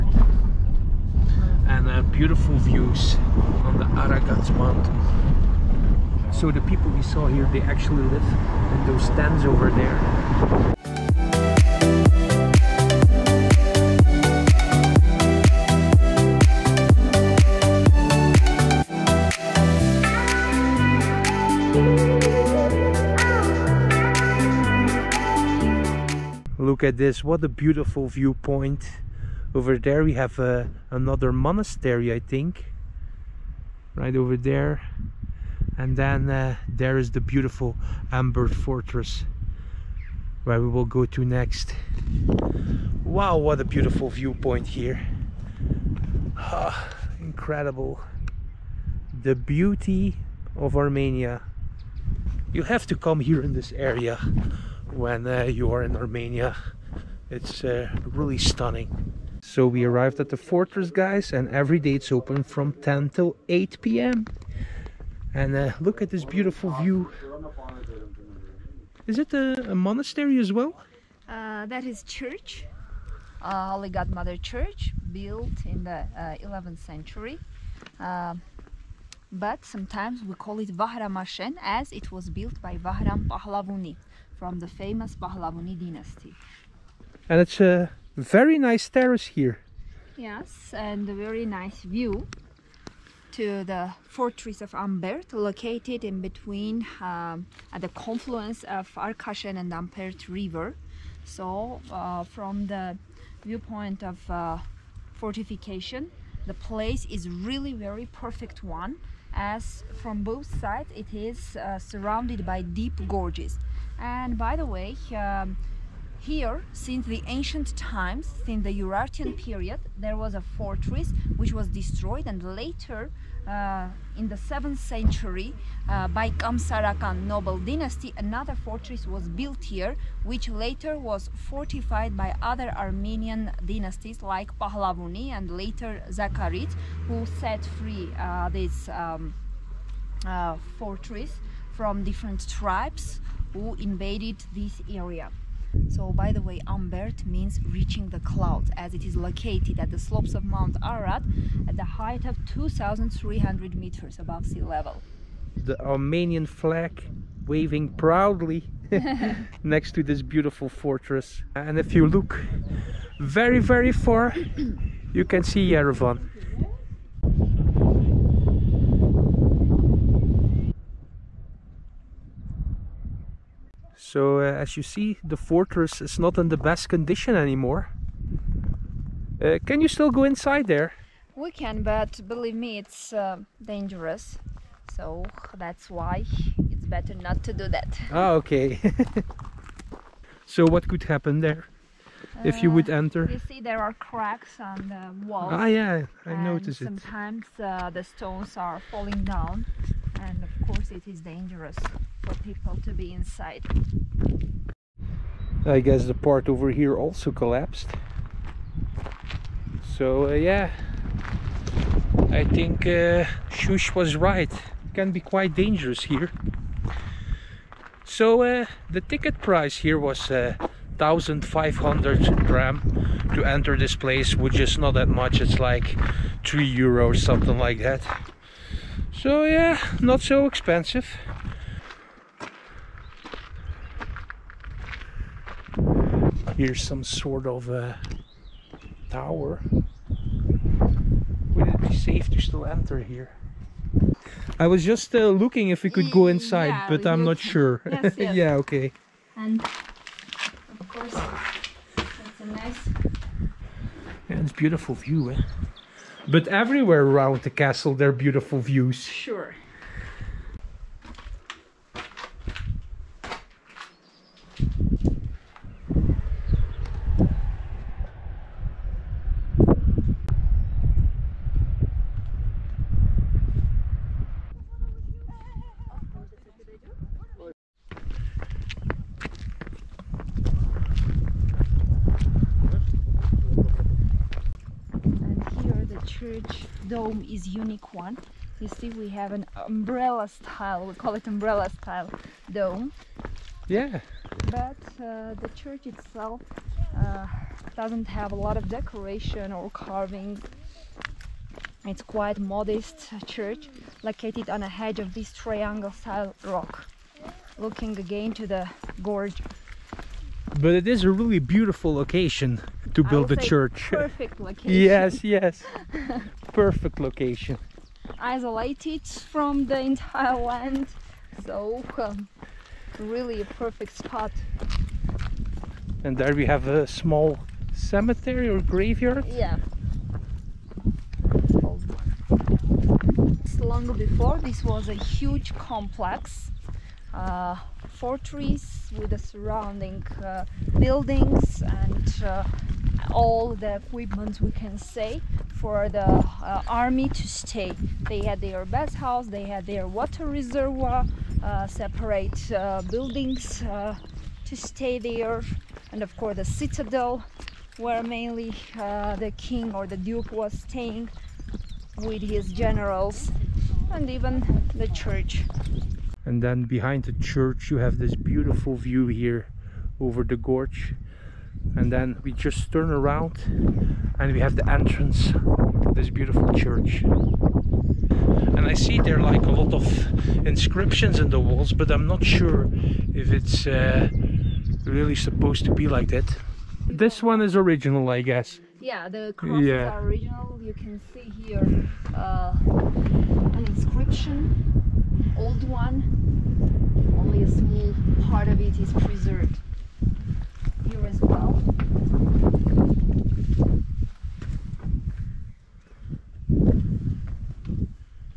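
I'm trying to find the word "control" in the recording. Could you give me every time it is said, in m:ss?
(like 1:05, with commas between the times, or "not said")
not said.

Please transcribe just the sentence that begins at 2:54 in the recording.
So uh, as you see, the fortress is not in the best condition anymore.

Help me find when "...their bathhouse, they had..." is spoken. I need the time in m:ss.
5:48.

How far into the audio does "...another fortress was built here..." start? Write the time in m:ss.
2:08.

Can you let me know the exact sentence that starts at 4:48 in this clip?
You see, we have an umbrella style, we call it umbrella style dome.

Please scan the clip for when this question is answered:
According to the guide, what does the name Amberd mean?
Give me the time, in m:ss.
2:27.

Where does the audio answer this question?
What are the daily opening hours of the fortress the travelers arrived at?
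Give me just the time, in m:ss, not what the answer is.
1:02.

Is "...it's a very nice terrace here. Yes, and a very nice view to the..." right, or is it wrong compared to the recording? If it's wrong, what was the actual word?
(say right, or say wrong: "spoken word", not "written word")
right.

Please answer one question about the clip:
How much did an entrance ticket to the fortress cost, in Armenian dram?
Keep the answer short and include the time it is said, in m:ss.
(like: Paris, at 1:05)
1500 dram, at 3:40.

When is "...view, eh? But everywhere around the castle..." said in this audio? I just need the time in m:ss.
4:14.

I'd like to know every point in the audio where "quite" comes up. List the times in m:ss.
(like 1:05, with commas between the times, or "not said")
3:35, 5:02.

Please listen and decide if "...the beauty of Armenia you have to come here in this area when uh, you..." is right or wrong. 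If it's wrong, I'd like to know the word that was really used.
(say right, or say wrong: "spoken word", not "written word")
right.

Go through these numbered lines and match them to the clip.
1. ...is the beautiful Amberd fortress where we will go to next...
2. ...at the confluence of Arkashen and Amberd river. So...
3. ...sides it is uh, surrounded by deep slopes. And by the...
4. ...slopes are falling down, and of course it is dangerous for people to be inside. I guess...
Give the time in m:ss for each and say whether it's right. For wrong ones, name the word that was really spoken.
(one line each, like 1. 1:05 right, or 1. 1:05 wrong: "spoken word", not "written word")
1. 0:36 right
2. 1:37 right
3. 1:50 wrong: "gorges", not "slopes"
4. 3:18 wrong: "stones", not "slopes".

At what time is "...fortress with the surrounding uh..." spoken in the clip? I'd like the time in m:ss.
5:38.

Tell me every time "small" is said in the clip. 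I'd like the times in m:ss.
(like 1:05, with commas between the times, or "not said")
5:26, 6:37.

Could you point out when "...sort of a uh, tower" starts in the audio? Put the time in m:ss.
3:57.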